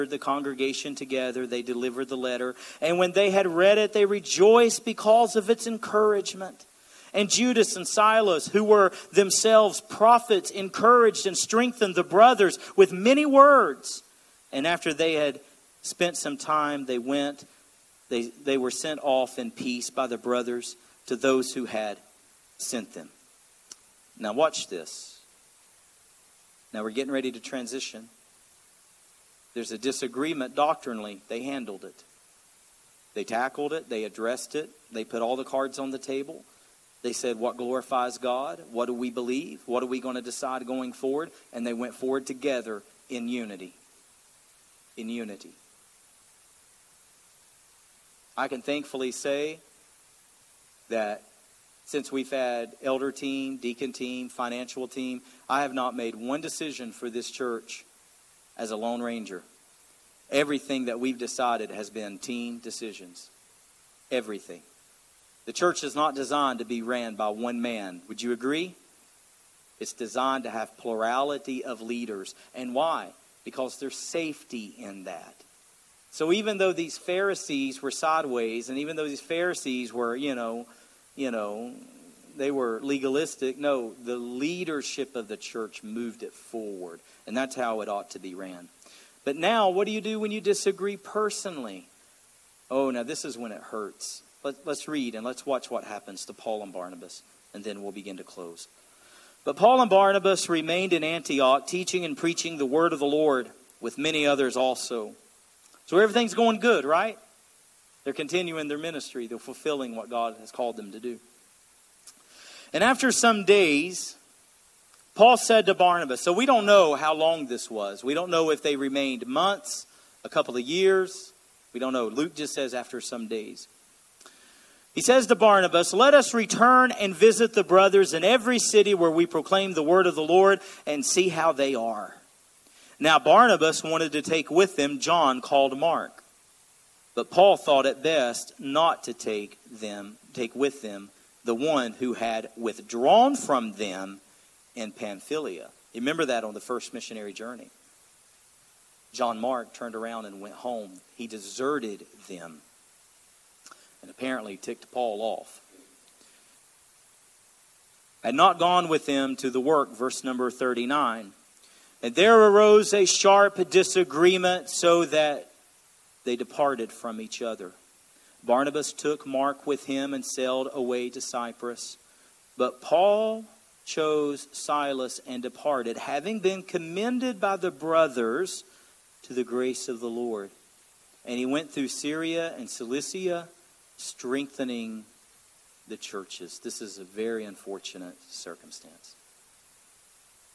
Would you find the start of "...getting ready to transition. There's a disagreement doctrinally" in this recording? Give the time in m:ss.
0:26.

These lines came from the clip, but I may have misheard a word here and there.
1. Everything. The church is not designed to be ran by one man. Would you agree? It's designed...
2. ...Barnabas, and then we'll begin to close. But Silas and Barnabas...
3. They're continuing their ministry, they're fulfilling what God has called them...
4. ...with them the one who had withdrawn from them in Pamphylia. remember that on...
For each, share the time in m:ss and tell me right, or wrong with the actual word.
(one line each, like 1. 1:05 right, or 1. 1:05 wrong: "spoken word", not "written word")
1. 1:04 right
2. 1:36 wrong: "Paul", not "Silas"
3. 1:48 right
4. 2:20 right.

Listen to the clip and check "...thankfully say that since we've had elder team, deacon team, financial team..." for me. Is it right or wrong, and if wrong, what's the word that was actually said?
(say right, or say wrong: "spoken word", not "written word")
right.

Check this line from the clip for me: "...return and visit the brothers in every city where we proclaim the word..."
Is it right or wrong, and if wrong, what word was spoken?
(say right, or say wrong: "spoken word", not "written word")
right.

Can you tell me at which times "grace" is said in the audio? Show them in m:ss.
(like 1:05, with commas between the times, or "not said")
2:59.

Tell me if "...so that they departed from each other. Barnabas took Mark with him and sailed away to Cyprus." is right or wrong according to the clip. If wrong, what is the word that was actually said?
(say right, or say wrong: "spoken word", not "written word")
right.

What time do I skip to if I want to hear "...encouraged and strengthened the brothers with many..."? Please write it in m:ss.
0:10.